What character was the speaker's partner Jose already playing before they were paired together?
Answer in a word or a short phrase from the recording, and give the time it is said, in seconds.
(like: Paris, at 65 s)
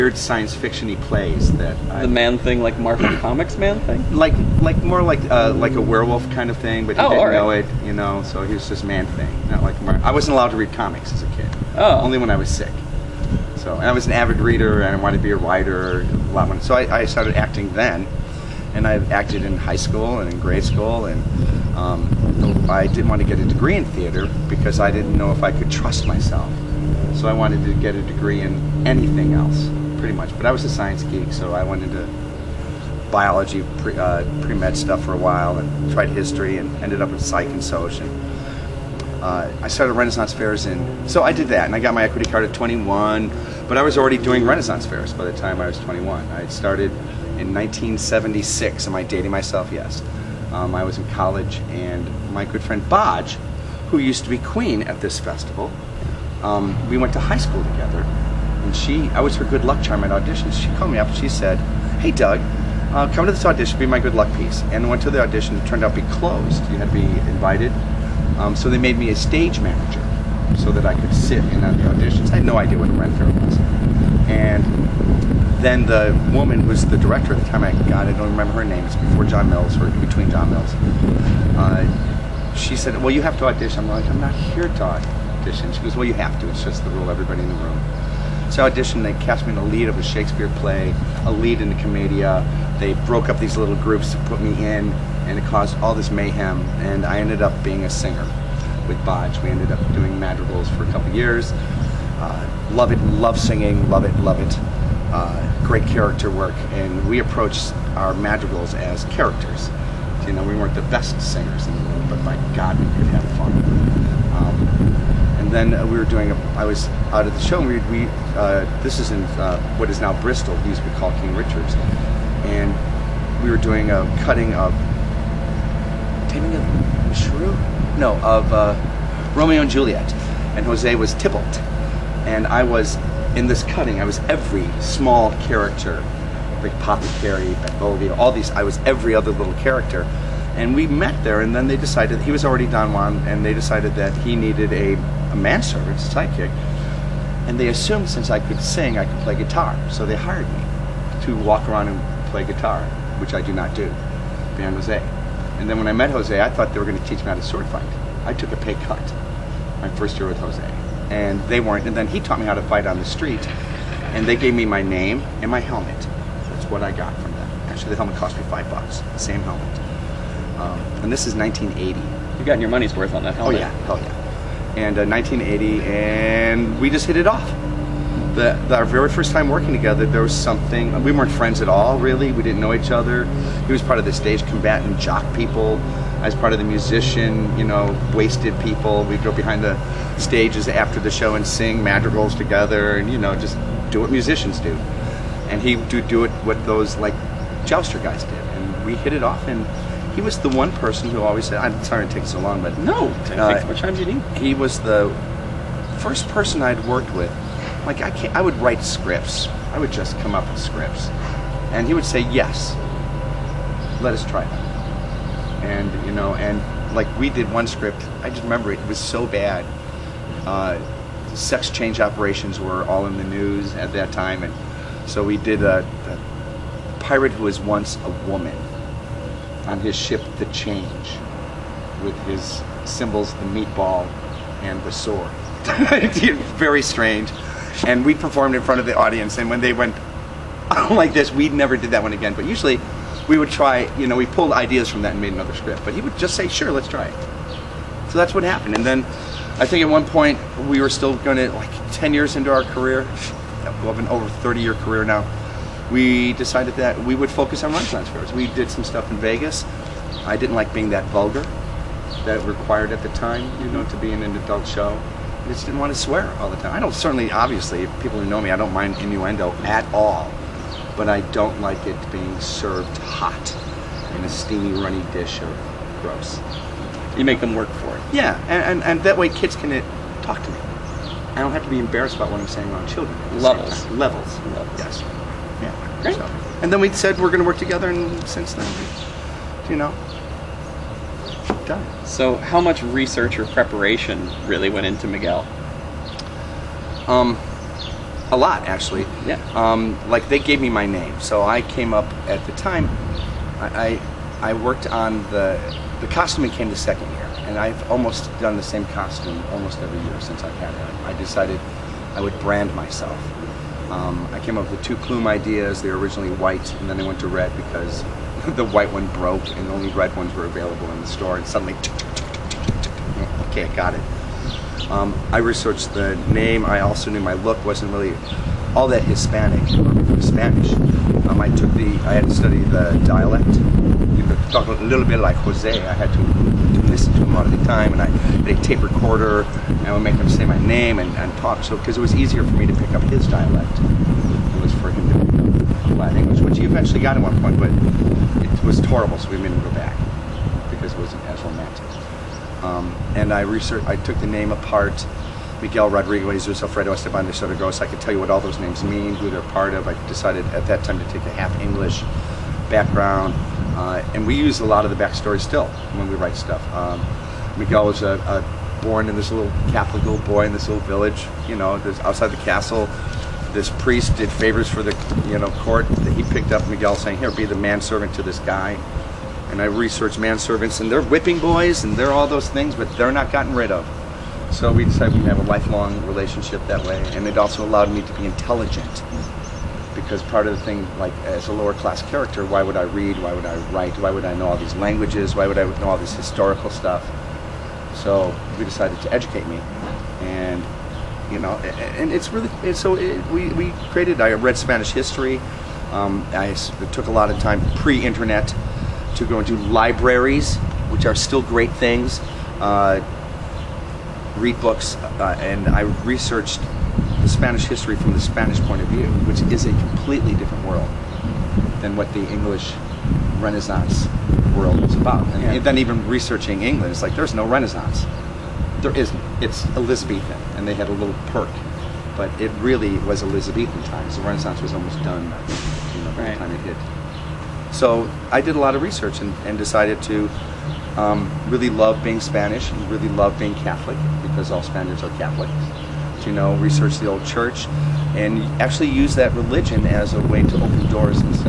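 Don Juan, at 142 s.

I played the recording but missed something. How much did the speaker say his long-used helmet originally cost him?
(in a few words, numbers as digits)
5 dollars.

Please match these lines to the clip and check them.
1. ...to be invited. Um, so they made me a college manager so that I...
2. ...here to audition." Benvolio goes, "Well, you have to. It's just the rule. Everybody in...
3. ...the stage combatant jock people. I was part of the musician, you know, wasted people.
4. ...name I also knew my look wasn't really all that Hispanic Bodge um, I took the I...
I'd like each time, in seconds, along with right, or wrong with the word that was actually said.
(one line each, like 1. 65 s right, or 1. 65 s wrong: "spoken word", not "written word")
1. 66 s wrong: "stage", not "college"
2. 84 s wrong: "She", not "Benvolio"
3. 184 s right
4. 326 s wrong: "Spanish", not "Bodge".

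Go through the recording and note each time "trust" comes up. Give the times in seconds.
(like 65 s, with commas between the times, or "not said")
25 s.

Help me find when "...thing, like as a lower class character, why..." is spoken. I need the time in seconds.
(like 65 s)
390 s.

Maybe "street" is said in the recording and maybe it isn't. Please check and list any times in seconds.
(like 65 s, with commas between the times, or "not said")
163 s.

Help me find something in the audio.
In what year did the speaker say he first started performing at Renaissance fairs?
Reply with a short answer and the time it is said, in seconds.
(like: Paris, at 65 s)
1976, at 47 s.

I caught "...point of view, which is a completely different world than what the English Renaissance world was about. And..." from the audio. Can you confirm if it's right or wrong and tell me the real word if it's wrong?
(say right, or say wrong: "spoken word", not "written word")
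right.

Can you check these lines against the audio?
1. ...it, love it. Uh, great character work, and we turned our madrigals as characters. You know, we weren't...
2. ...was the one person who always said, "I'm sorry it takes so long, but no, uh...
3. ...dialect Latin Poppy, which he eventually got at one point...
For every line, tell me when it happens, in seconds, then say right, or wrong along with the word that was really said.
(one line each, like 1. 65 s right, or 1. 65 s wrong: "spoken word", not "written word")
1. 104 s wrong: "approached", not "turned"
2. 200 s right
3. 343 s wrong: "English", not "Poppy".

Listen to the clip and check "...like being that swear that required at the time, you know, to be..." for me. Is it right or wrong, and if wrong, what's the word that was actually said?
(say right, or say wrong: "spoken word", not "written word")
wrong: "vulgar", not "swear".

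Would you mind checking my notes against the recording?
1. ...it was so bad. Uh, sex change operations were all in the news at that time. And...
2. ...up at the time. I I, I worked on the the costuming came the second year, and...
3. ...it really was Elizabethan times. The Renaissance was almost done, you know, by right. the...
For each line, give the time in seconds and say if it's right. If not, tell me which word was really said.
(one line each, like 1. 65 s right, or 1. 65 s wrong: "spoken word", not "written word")
1. 218 s right
2. 301 s right
3. 432 s right.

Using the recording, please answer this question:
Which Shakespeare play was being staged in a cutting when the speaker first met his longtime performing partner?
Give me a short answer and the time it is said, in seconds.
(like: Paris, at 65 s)
Romeo and Juliet, at 129 s.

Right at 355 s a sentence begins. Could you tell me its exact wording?
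Miguel Rodriguez de Alfredo Esteban de Sotogross.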